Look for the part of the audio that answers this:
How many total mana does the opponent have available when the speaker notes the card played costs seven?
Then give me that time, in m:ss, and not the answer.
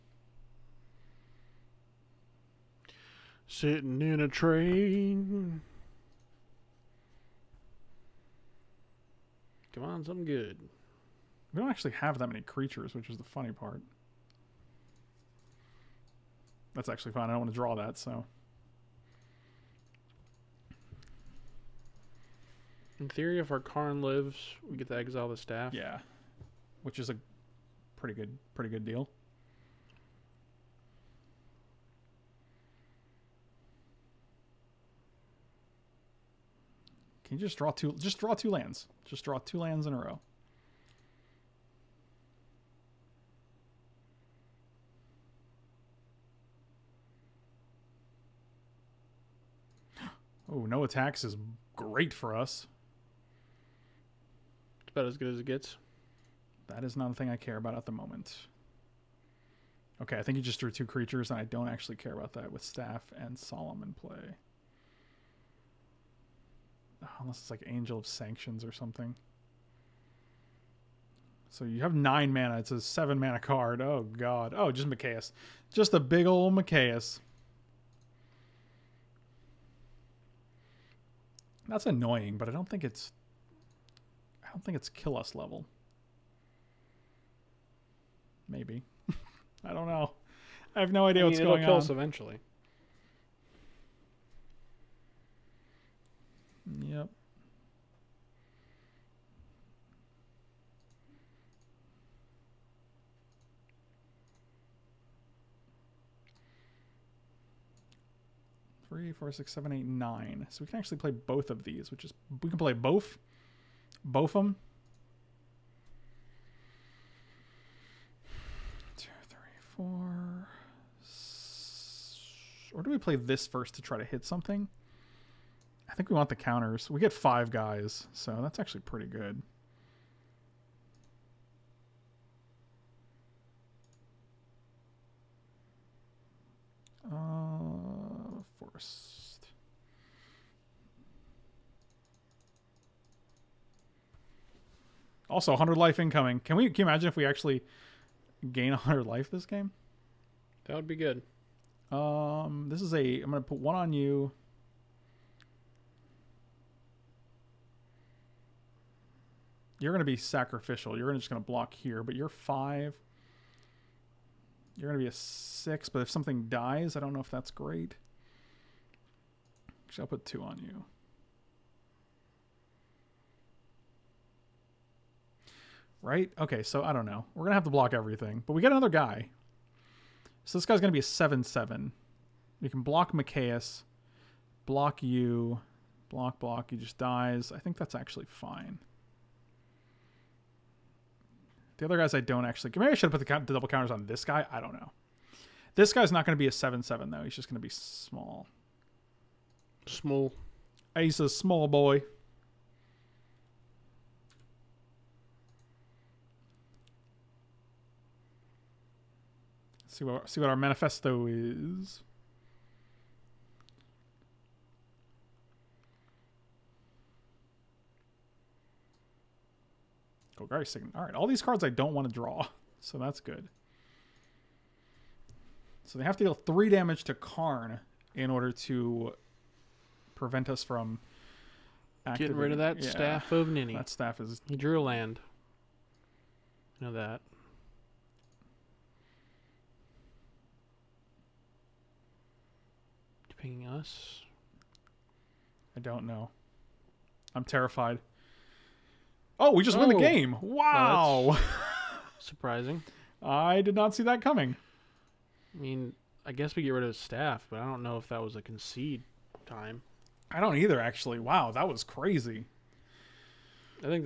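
1:11.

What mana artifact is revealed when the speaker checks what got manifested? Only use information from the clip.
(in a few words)
Golgari Signet.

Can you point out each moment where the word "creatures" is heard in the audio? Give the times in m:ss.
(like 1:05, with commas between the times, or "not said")
0:12, 1:00.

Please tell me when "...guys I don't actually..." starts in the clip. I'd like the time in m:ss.
3:11.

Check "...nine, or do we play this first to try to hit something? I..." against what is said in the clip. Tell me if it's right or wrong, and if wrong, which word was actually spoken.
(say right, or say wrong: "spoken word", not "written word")
wrong: "four", not "nine".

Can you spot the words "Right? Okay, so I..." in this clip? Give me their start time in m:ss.
2:56.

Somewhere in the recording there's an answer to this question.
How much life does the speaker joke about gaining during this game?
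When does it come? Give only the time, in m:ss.
2:25.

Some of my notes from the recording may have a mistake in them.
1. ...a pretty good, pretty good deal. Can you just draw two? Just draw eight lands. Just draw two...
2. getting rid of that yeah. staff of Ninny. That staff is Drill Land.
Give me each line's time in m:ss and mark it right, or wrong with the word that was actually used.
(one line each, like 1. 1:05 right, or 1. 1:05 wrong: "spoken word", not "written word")
1. 0:27 wrong: "two", not "eight"
2. 3:52 right.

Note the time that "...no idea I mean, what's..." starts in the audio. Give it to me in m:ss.
1:30.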